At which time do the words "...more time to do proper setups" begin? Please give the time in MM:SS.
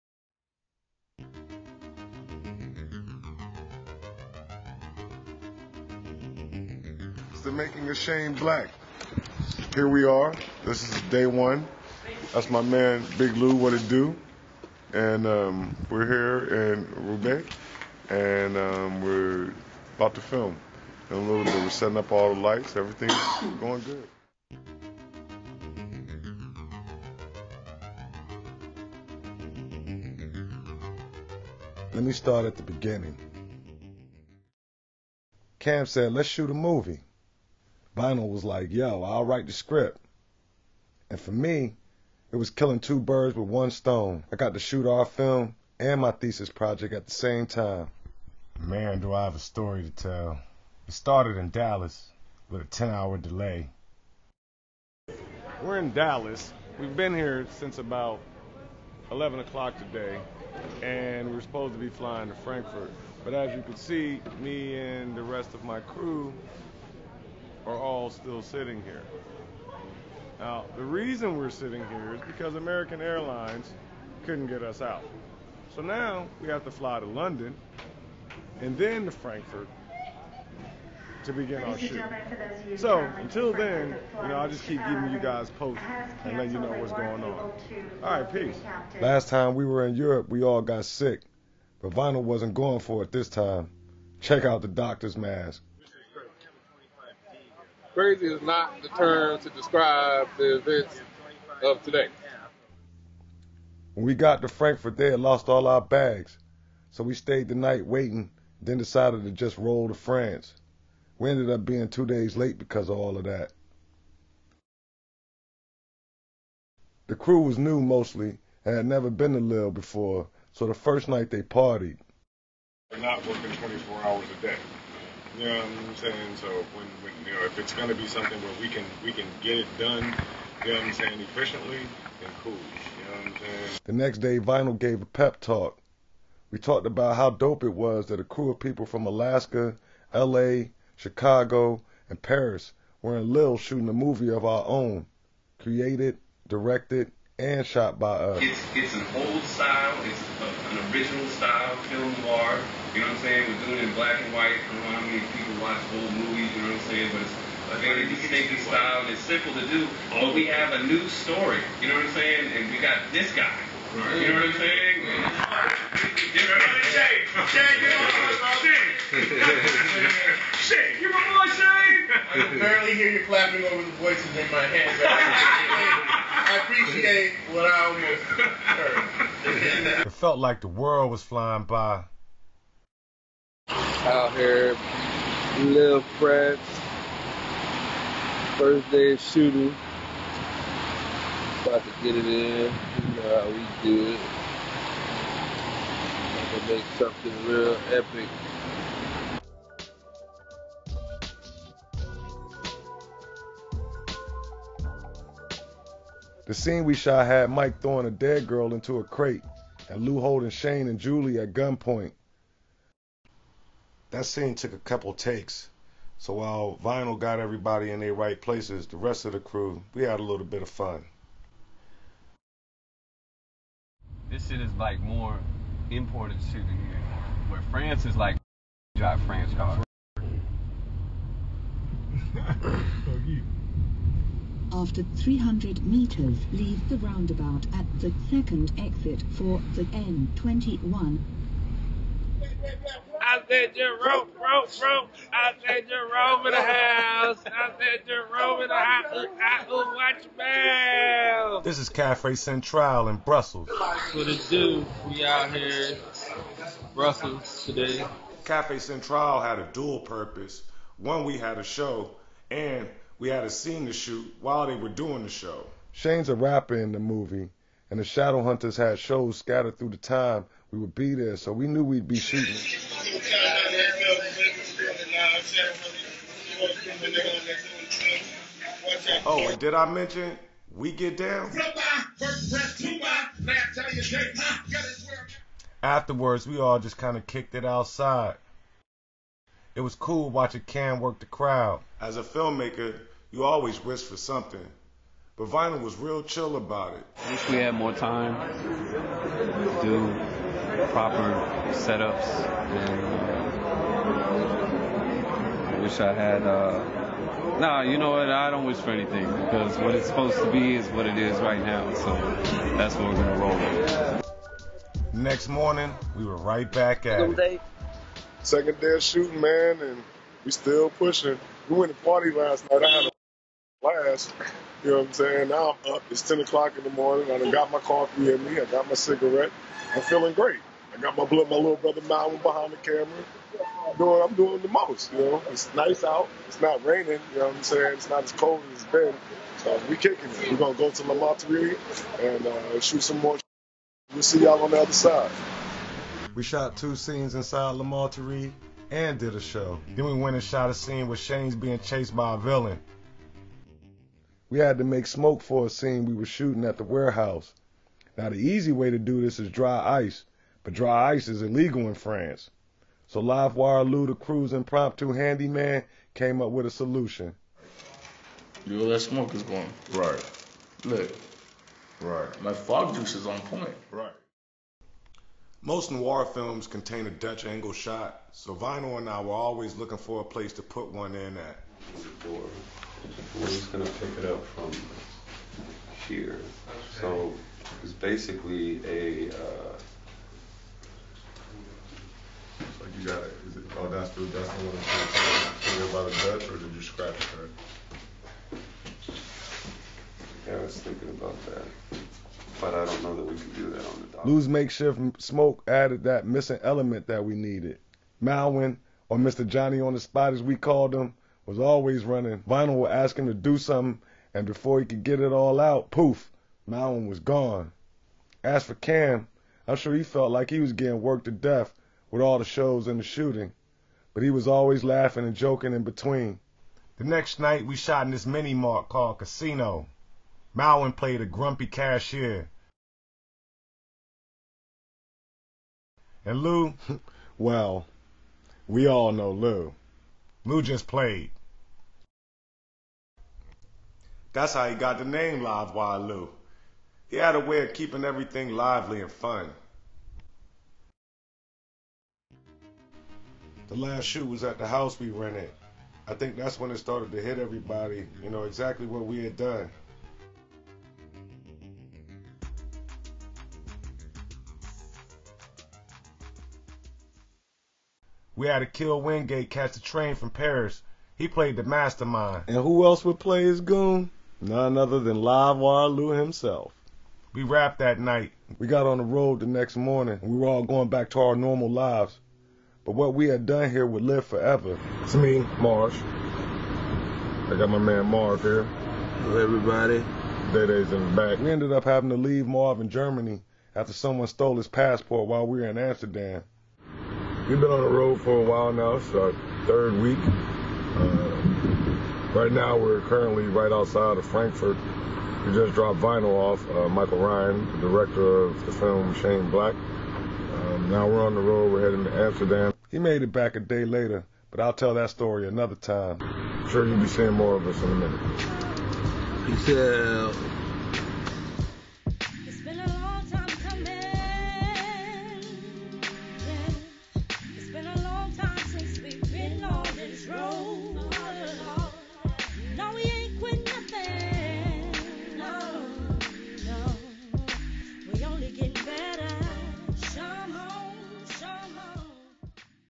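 04:57.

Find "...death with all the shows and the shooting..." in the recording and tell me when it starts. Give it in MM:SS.
07:01.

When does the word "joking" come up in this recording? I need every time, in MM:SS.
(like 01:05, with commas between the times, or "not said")
07:05.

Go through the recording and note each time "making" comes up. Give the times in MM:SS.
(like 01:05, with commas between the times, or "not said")
00:07.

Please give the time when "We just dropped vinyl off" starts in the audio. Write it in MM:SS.
08:25.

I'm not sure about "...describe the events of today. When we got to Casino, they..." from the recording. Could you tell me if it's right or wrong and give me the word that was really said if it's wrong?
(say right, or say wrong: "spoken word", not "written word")
wrong: "Frankfurt", not "Casino".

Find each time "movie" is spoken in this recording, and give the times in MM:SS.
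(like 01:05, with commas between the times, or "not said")
00:36, 02:23, 02:36, 04:26.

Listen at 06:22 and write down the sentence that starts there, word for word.
we We're just gonna pick it up from here.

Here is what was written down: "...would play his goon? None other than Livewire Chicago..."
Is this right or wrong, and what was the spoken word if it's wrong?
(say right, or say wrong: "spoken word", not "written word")
wrong: "Lou", not "Chicago".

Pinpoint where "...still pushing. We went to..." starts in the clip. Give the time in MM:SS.
05:20.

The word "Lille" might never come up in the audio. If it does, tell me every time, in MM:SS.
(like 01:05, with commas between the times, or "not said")
01:59, 02:23.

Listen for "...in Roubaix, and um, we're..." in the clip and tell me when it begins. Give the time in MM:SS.
00:16.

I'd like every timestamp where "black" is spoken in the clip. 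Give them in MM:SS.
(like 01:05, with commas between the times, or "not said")
00:08, 02:33, 08:29.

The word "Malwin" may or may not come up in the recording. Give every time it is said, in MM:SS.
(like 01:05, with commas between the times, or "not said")
06:48, 06:56, 07:10.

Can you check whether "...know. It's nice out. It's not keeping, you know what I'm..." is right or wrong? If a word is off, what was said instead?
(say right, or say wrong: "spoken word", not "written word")
wrong: "raining", not "keeping".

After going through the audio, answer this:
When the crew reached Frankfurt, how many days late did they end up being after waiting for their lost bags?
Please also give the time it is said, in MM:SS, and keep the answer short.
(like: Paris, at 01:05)
2 days, at 01:51.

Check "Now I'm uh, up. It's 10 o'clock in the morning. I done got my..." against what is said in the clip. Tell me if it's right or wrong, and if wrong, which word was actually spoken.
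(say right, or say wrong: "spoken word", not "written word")
right.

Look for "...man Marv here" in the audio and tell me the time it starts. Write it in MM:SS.
08:07.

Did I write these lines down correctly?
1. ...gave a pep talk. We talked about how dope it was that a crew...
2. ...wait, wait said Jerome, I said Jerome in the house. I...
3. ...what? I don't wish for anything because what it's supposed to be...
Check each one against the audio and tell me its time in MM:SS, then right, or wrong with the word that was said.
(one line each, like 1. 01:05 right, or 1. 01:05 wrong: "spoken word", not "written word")
1. 02:14 right
2. 04:02 right
3. 05:08 right.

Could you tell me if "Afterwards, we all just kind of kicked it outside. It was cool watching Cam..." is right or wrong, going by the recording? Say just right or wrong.
right.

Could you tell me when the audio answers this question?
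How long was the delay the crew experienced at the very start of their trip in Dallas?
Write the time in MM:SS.
00:52.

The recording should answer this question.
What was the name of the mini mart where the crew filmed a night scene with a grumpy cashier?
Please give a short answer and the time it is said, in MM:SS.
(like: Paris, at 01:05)
Casino, at 07:09.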